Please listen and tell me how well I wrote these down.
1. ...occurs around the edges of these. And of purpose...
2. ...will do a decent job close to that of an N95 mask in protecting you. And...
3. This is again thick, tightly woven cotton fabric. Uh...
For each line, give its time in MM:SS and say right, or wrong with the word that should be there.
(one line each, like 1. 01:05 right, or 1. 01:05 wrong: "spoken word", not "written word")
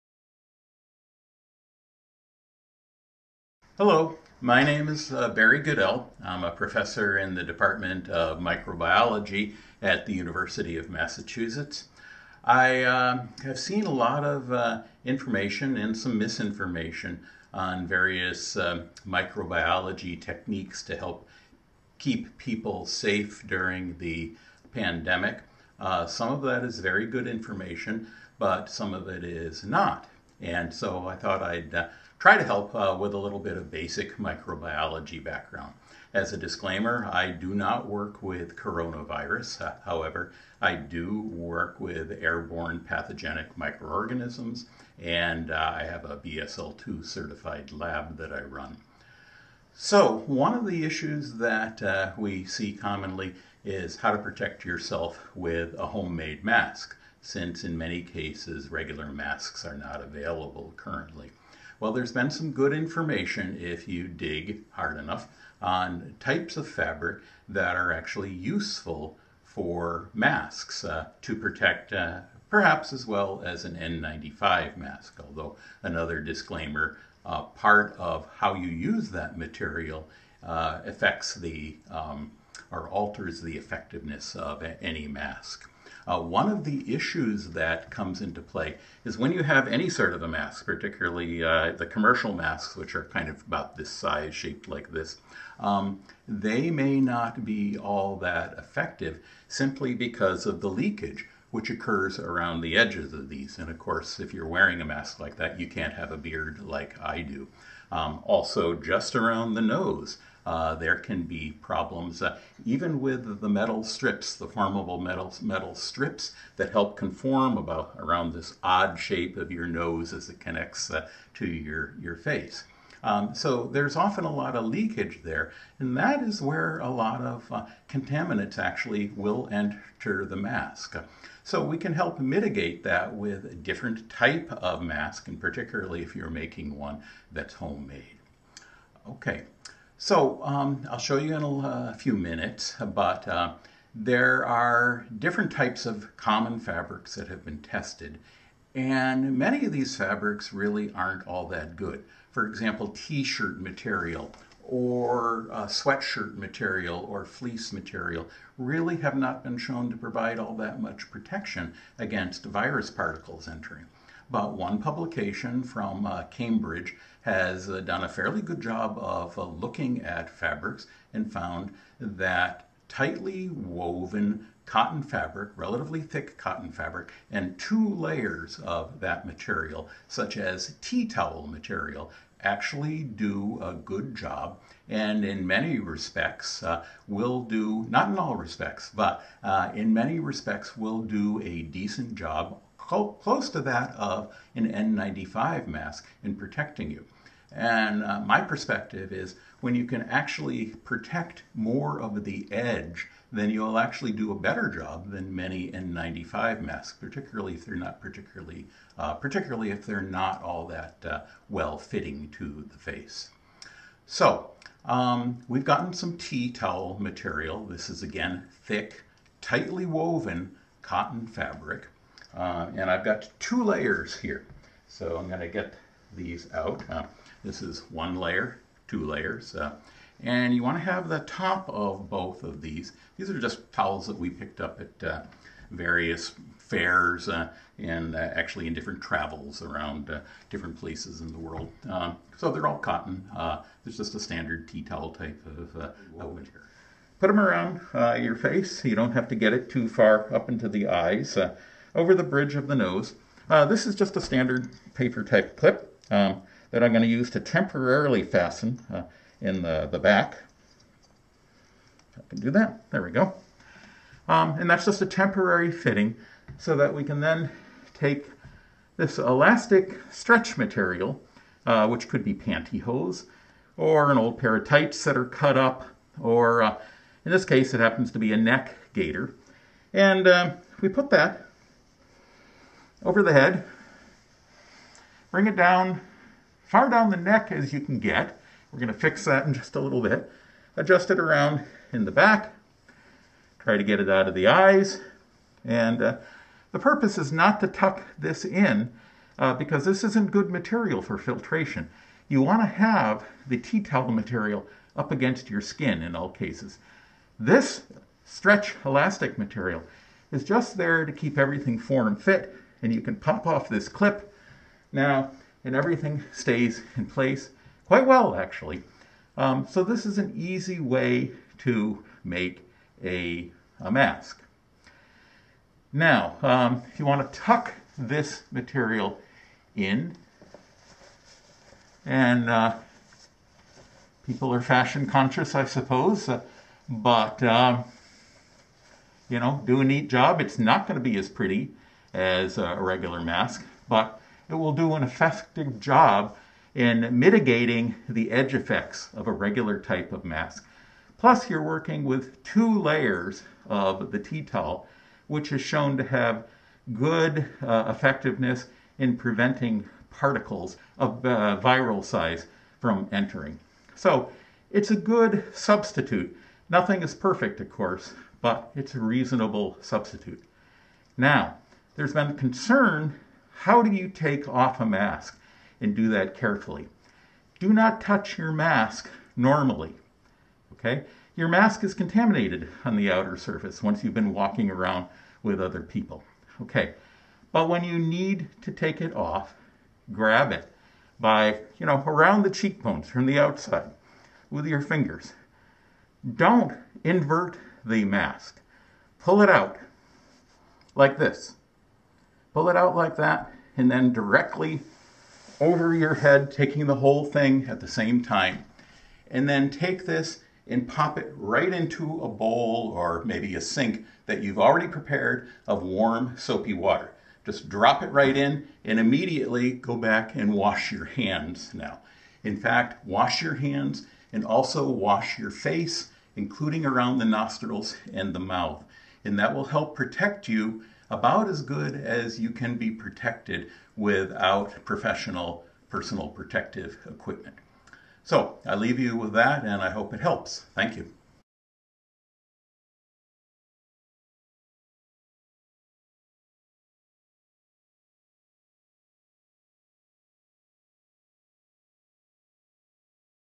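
1. 01:41 wrong: "course", not "purpose"
2. 03:10 right
3. 03:37 right.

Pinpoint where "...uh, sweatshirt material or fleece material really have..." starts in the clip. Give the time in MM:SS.
02:35.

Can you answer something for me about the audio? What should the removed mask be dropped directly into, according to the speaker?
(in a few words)
Warm soapy water.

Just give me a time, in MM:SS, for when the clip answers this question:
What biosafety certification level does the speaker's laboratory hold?
00:46.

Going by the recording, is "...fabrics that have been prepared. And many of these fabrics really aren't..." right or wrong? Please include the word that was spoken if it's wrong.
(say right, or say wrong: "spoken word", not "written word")
wrong: "tested", not "prepared".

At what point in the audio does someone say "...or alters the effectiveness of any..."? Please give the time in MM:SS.
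01:22.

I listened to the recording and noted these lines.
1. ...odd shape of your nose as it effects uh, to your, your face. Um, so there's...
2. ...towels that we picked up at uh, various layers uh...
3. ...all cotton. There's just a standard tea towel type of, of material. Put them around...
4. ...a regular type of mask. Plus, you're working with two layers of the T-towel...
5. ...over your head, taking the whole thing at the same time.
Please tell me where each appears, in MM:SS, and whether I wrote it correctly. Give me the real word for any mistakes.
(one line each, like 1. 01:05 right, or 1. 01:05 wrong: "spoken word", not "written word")
1. 01:58 wrong: "connects", not "effects"
2. 03:53 wrong: "fairs", not "layers"
3. 04:02 right
4. 05:49 right
5. 06:45 right.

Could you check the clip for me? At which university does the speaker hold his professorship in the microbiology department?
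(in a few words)
University of Massachusetts.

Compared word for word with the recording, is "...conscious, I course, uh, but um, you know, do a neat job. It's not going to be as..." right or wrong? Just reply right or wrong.
wrong.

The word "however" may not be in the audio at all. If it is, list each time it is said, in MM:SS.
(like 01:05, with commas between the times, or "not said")
00:39.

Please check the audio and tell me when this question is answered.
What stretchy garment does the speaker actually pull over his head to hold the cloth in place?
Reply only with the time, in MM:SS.
04:38.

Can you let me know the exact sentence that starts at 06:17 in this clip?
Do not touch your mask normally.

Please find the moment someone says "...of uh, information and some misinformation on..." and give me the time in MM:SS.
00:14.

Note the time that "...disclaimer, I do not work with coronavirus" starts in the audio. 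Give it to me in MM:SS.
00:36.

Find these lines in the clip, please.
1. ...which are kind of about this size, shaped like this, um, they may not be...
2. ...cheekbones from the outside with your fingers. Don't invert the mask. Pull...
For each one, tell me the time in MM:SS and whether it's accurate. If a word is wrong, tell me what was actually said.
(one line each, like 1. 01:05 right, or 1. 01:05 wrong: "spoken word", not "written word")
1. 01:32 right
2. 06:32 right.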